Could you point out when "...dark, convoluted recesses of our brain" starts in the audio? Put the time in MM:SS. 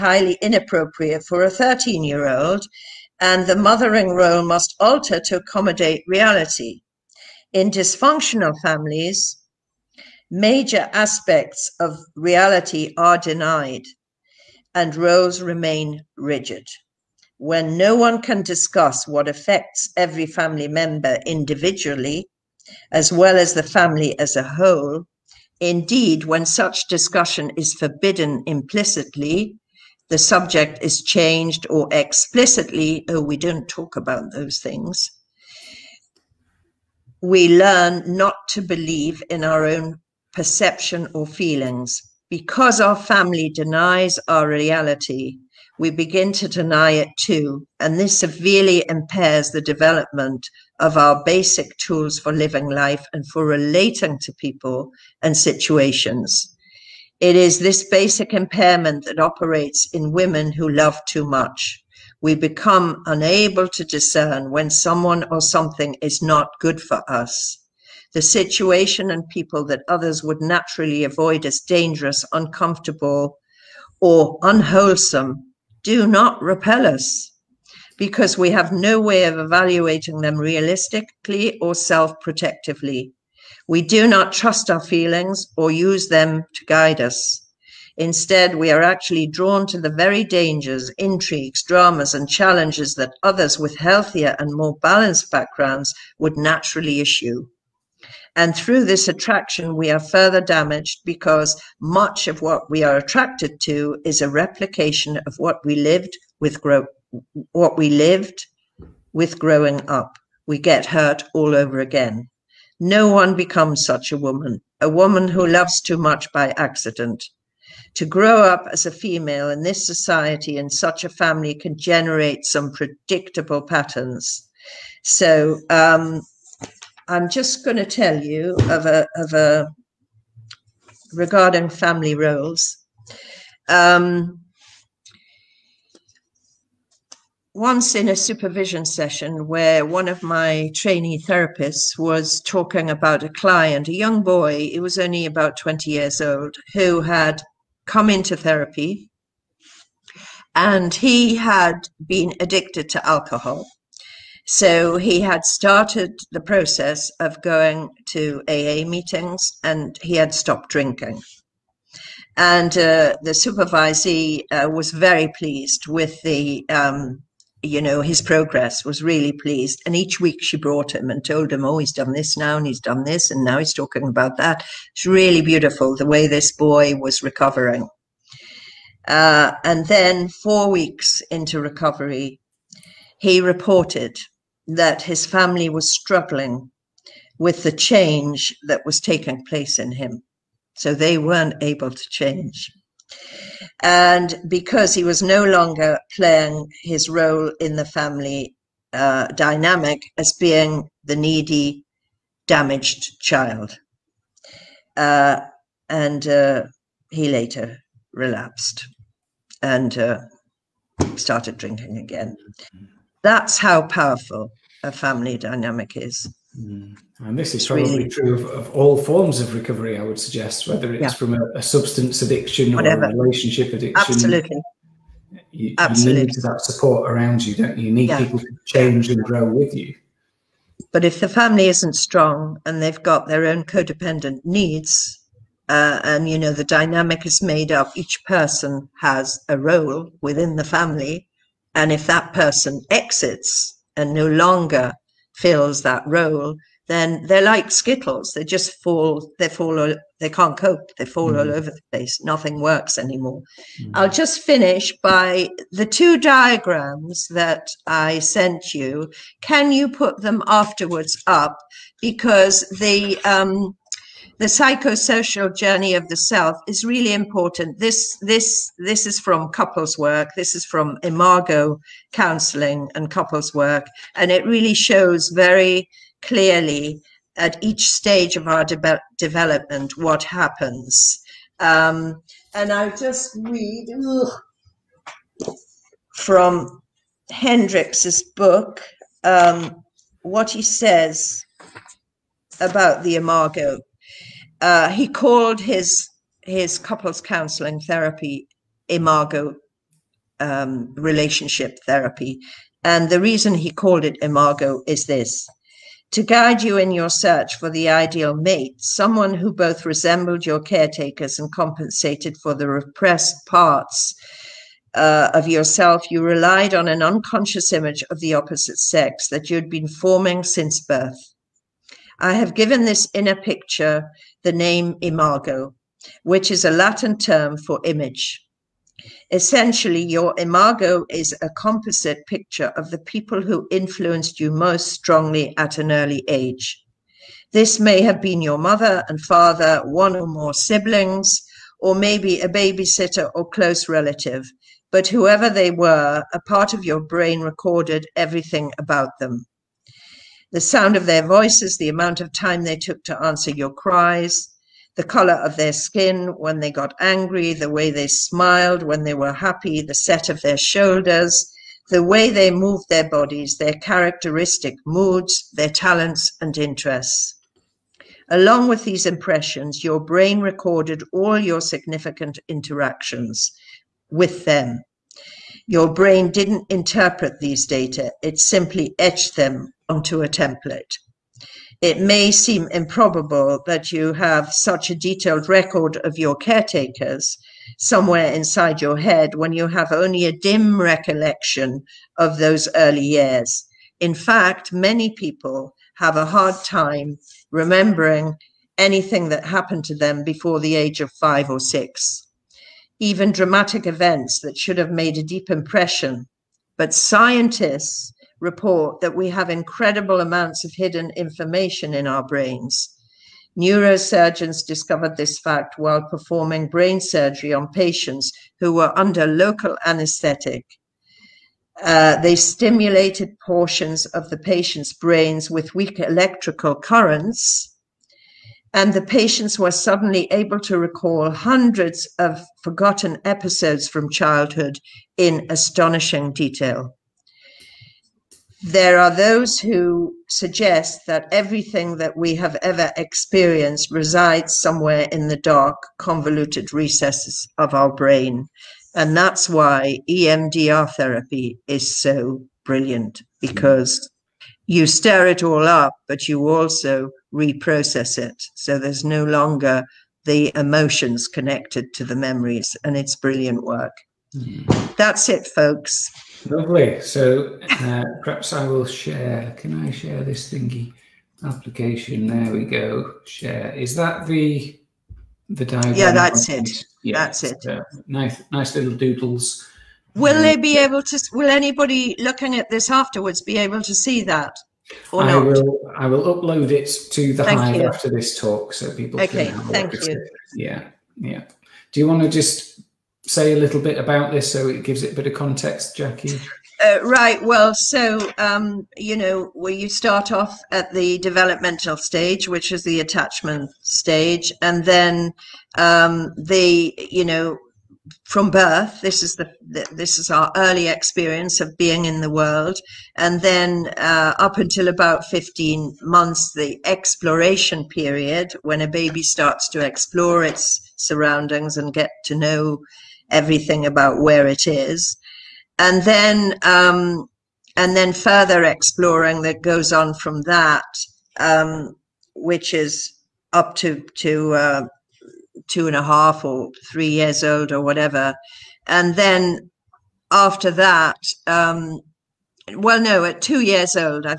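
07:25.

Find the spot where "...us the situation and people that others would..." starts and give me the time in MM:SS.
01:07.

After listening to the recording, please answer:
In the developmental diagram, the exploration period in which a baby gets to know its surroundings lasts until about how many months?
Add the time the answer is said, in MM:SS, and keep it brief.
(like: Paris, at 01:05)
15, at 08:35.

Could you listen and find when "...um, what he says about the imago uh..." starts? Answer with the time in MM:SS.
04:49.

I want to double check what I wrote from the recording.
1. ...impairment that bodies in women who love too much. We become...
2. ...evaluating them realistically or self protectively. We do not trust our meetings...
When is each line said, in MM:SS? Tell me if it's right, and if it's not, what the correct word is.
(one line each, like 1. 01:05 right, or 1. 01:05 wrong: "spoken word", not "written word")
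1. 00:58 wrong: "operates", not "bodies"
2. 01:19 wrong: "feelings", not "meetings".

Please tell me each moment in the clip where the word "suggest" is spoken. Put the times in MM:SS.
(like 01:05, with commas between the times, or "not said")
03:40, 07:20.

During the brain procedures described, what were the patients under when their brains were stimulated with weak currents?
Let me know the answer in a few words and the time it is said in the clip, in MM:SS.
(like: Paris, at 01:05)
local anesthetic, at 06:59.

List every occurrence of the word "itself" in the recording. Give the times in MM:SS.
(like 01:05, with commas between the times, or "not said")
not said.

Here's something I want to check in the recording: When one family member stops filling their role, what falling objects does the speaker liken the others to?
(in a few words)
skittles.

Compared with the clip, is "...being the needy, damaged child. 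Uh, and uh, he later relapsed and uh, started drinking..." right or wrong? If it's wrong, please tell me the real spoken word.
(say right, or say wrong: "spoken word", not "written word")
right.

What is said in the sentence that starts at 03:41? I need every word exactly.
from a, a, substance addiction Whatever.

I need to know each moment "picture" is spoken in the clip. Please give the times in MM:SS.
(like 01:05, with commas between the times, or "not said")
05:23, 05:32.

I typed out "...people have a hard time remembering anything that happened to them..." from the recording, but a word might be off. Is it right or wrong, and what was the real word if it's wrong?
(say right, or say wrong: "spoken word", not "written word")
right.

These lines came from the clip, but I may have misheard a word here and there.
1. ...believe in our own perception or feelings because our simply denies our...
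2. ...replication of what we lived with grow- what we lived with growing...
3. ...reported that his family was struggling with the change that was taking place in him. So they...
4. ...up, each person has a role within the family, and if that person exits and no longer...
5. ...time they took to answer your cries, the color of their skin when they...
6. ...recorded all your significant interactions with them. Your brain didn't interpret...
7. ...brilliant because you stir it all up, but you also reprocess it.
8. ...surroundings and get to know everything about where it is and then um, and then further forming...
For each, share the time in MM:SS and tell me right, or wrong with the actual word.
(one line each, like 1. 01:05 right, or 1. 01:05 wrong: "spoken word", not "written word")
1. 00:38 wrong: "family", not "simply"
2. 01:44 right
3. 03:03 right
4. 03:57 right
5. 05:52 right
6. 06:10 right
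7. 07:32 right
8. 08:40 wrong: "exploring", not "forming".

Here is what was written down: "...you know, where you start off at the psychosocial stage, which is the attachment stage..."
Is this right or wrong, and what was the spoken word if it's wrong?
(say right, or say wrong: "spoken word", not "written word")
wrong: "developmental", not "psychosocial".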